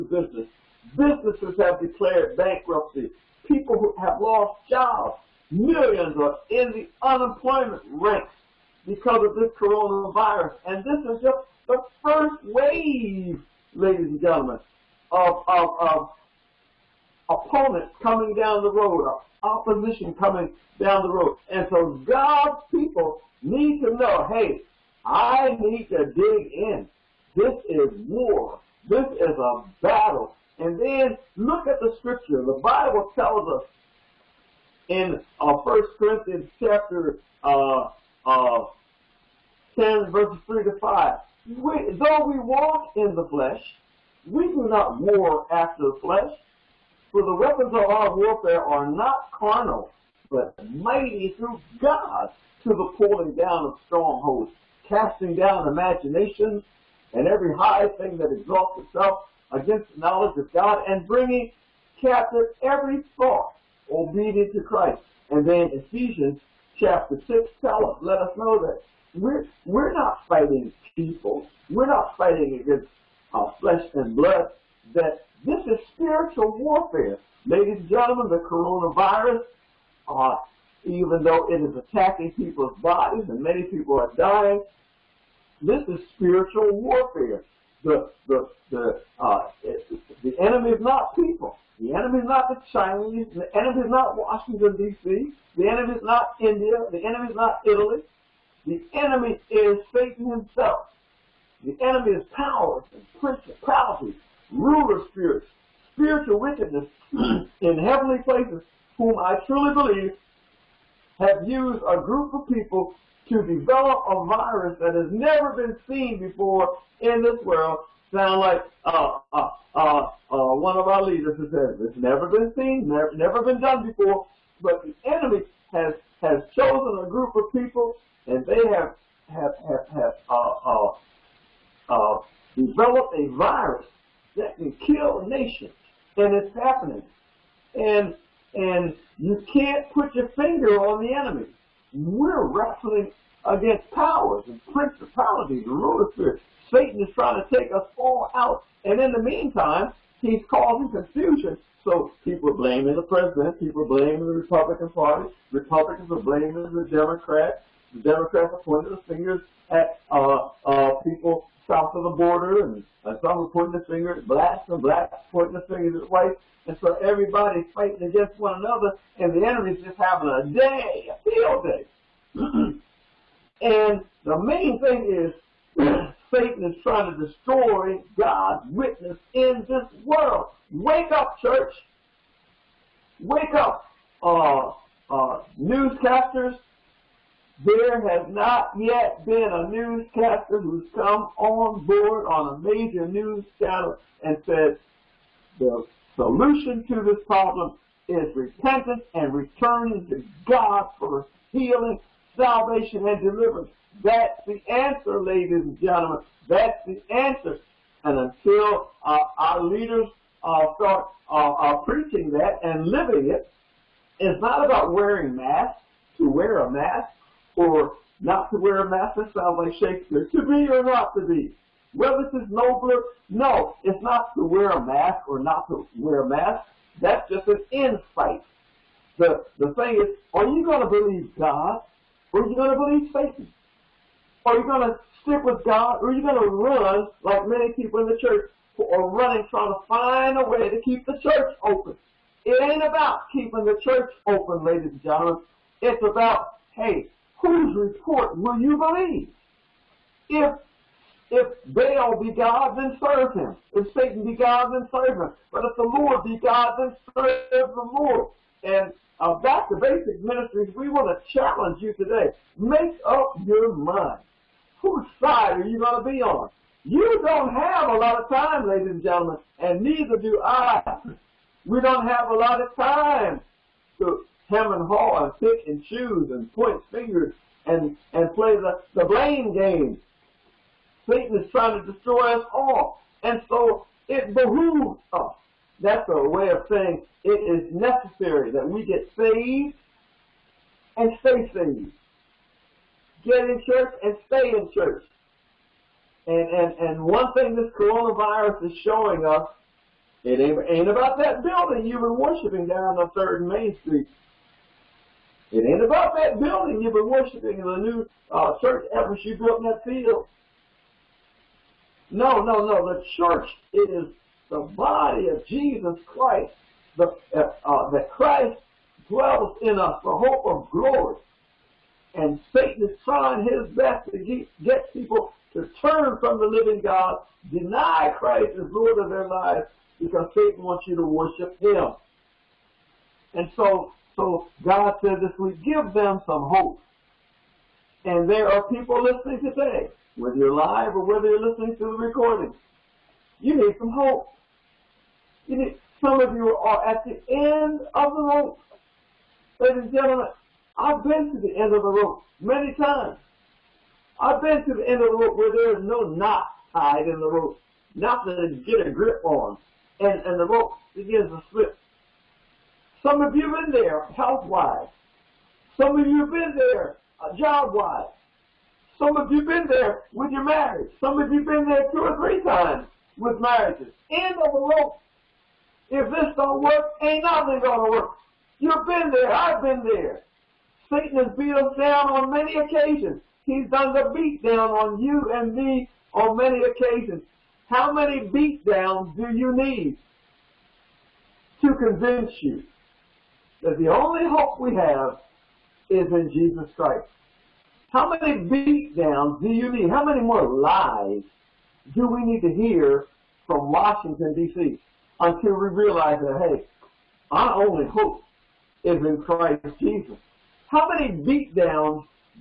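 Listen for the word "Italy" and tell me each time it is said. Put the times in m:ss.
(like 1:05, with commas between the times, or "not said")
1:37.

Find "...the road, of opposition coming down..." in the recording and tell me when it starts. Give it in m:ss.
0:18.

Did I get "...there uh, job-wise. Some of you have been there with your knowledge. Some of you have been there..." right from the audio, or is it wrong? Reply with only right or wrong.
wrong.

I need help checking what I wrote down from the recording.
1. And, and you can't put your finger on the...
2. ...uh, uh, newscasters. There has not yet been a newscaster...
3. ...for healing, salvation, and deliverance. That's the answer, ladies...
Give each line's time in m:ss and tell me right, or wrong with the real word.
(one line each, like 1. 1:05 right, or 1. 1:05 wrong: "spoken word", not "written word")
1. 2:17 right
2. 3:04 right
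3. 3:20 right.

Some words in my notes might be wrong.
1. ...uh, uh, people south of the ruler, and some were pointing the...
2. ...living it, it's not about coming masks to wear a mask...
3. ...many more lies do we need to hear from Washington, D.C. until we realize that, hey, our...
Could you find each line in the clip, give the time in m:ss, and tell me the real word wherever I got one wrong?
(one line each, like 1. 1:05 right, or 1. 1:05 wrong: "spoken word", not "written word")
1. 2:40 wrong: "border", not "ruler"
2. 3:32 wrong: "wearing", not "coming"
3. 6:40 right.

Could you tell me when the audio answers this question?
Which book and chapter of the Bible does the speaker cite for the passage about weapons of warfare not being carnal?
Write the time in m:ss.
0:35.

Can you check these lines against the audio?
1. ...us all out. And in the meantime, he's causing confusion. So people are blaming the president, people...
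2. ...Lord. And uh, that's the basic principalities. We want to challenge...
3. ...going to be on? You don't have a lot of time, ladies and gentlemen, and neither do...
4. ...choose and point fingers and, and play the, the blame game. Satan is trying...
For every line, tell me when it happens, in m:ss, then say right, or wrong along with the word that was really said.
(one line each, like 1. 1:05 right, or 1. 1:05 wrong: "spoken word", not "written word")
1. 2:27 right
2. 4:17 wrong: "ministries", not "principalities"
3. 4:25 right
4. 4:35 right.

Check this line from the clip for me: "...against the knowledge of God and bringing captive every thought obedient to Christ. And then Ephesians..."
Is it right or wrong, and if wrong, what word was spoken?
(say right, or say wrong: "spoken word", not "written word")
right.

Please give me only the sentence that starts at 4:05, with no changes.
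It's about, hey, whose report will you believe?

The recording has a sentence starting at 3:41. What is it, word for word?
Whether it's nobler, no, it's not to wear a mask or not to wear a mask.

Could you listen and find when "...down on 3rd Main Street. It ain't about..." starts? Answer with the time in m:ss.
5:02.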